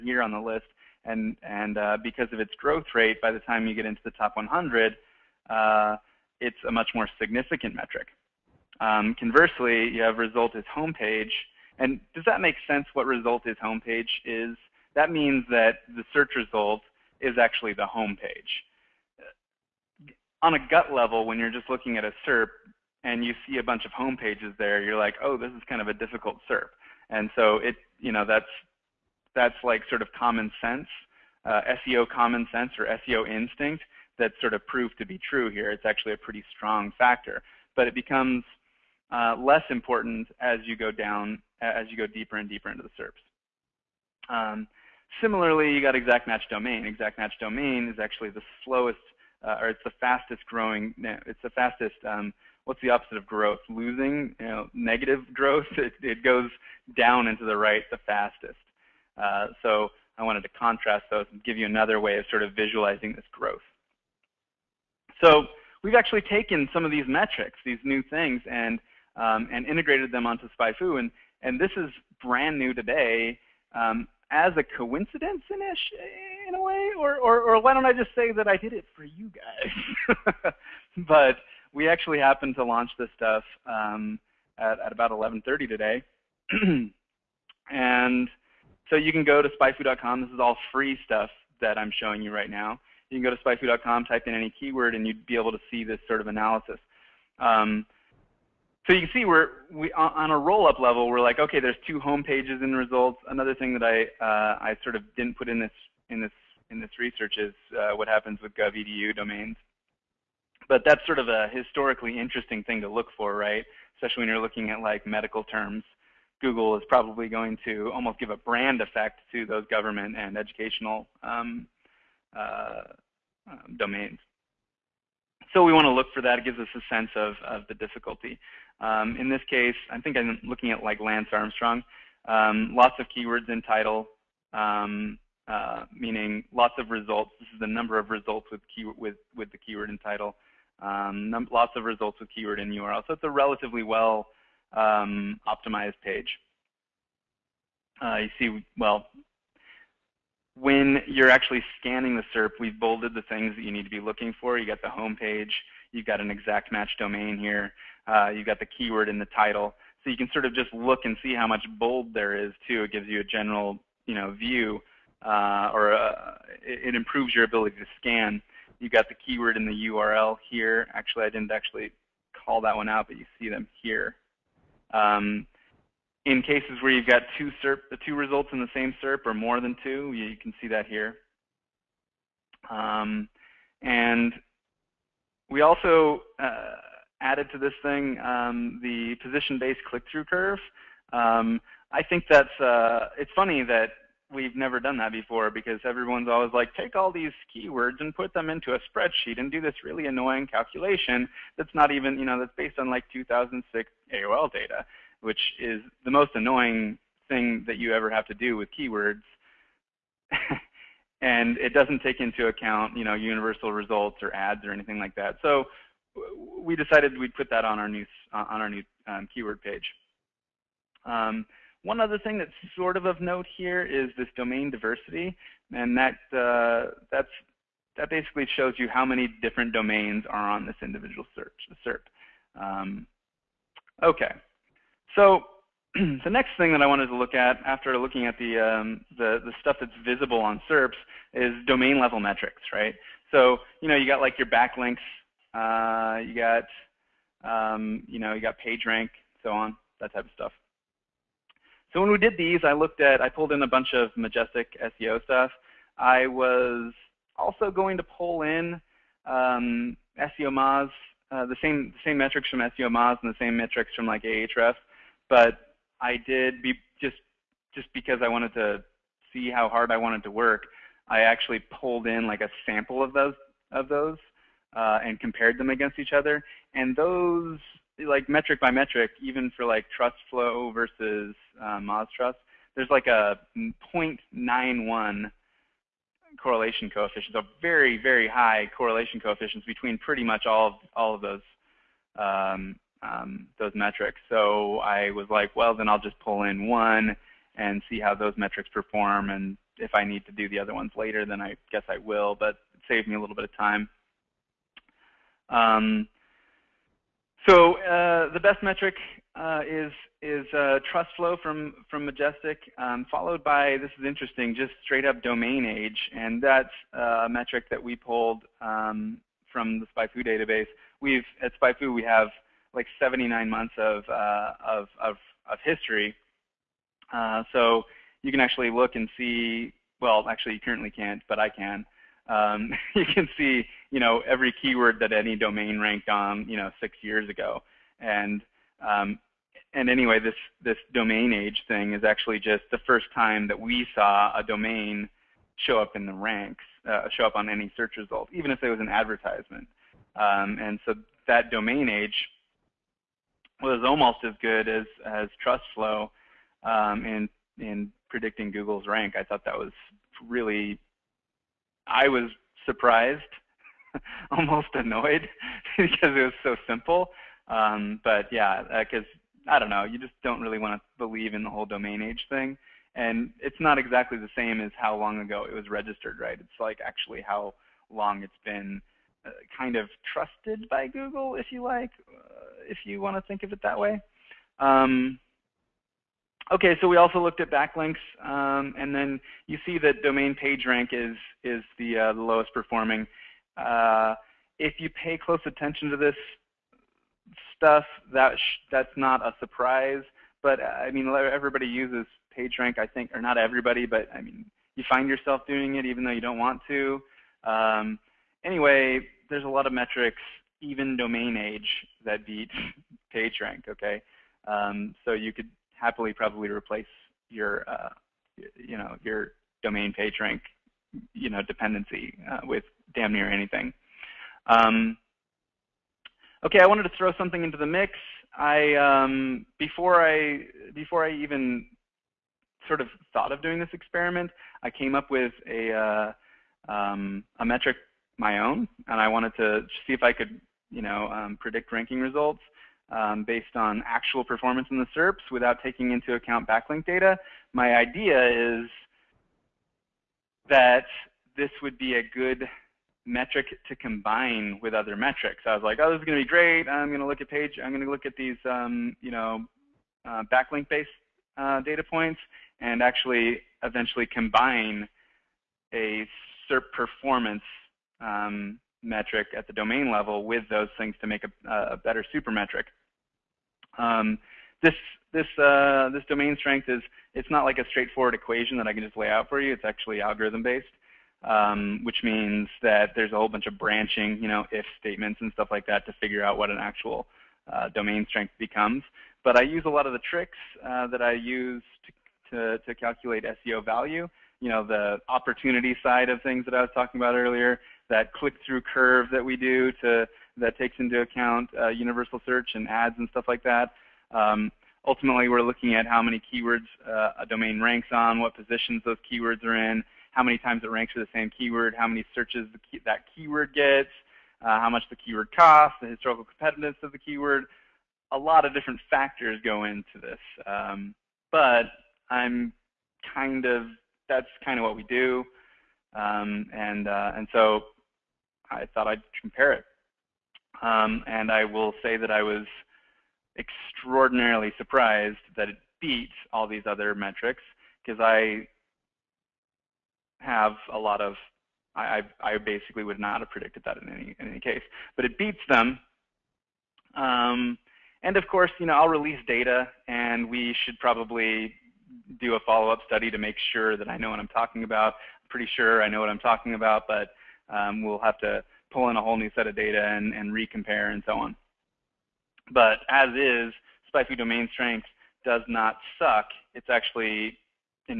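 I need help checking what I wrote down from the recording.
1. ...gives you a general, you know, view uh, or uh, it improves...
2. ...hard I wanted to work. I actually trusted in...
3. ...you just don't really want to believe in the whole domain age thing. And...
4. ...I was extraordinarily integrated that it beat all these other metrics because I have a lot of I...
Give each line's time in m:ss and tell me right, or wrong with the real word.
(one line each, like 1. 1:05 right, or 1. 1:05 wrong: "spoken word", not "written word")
1. 2:42 right
2. 4:29 wrong: "pulled", not "trusted"
3. 6:09 right
4. 8:52 wrong: "surprised", not "integrated".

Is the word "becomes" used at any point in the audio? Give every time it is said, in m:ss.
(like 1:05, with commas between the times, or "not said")
0:37, 8:08.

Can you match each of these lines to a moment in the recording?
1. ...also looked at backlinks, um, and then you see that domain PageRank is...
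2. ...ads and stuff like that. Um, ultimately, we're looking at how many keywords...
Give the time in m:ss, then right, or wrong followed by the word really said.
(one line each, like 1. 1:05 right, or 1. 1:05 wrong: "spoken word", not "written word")
1. 6:26 right
2. 8:22 right.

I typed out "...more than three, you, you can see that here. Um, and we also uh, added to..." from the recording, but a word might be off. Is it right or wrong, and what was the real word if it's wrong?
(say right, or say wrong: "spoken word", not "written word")
wrong: "two", not "three".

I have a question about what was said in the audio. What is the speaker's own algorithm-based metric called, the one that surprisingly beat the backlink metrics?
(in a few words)
SpyFu Domain Strength.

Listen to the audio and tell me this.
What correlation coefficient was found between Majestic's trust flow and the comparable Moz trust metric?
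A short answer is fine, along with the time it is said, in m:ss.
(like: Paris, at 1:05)
0.91, at 4:43.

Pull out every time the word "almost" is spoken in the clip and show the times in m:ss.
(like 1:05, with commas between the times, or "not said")
1:57, 5:53, 6:04.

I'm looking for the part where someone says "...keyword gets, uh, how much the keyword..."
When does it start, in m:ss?
8:33.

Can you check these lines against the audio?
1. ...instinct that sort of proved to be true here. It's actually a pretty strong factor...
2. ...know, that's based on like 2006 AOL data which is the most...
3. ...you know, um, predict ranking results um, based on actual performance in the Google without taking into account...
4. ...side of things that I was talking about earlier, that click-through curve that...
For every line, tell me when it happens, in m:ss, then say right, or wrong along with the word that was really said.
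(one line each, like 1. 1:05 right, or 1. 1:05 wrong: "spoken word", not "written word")
1. 0:33 right
2. 3:22 right
3. 7:20 wrong: "SERPs", not "Google"
4. 8:15 right.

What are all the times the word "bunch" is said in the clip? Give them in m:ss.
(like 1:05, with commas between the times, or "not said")
0:23, 4:13, 8:03.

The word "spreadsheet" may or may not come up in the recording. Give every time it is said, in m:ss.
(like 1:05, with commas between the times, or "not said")
3:18.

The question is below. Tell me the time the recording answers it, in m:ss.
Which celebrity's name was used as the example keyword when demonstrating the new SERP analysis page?
2:10.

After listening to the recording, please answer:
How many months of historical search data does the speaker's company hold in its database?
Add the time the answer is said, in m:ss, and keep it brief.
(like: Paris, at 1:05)
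79, at 5:22.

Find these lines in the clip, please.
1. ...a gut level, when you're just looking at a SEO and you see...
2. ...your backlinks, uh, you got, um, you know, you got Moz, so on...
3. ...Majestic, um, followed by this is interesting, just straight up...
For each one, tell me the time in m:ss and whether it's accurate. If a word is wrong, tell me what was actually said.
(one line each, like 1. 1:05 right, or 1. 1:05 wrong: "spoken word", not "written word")
1. 0:20 wrong: "SERP", not "SEO"
2. 4:04 wrong: "PageRank", not "Moz"
3. 5:12 right.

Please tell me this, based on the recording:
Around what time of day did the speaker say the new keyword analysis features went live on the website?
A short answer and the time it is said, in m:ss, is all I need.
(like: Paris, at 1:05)
11:30, at 1:25.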